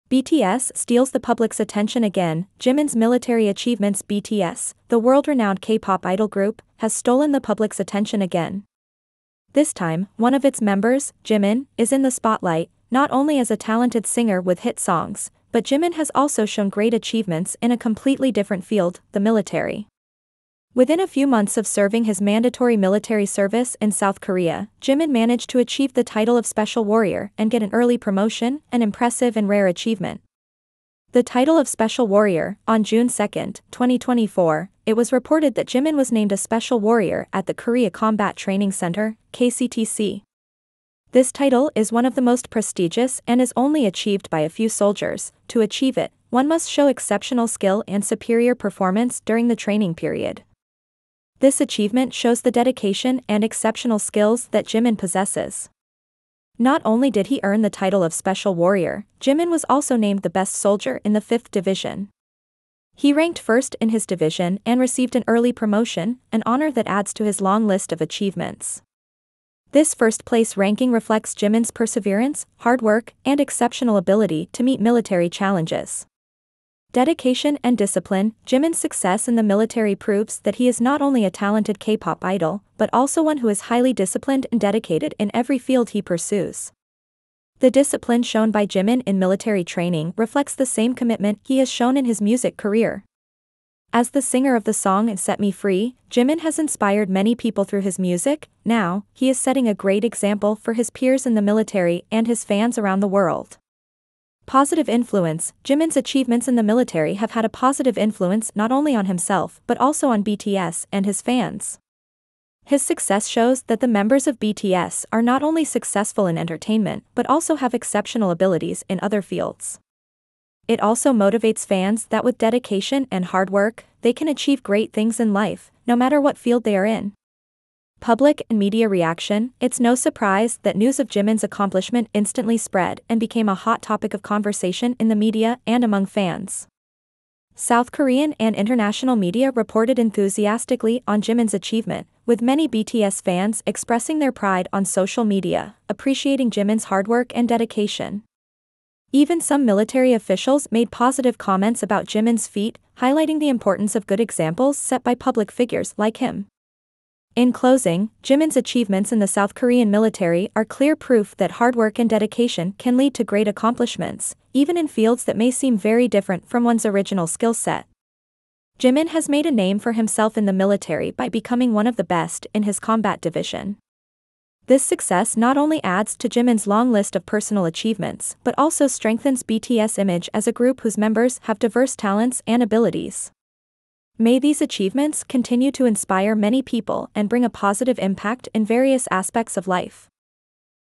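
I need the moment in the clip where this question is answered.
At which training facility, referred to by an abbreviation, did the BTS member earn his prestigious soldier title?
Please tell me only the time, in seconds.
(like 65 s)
37 s.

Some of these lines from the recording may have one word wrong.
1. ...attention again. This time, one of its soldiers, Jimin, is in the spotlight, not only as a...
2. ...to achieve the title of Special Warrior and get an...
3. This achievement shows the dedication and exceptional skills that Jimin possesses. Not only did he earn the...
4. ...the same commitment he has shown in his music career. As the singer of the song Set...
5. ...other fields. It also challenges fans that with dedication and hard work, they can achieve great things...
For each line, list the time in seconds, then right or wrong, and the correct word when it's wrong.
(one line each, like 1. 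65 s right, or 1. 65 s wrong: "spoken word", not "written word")
1. 7 s wrong: "members", not "soldiers"
2. 25 s right
3. 51 s right
4. 90 s right
5. 119 s wrong: "motivates", not "challenges".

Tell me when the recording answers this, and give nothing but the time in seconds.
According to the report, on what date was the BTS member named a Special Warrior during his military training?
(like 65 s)
32 s.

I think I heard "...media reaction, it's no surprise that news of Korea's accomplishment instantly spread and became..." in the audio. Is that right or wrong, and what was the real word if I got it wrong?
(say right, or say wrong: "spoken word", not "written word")
wrong: "Jimin", not "Korea".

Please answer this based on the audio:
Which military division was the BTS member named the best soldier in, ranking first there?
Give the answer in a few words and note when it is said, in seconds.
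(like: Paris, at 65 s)
5th Division, at 61 s.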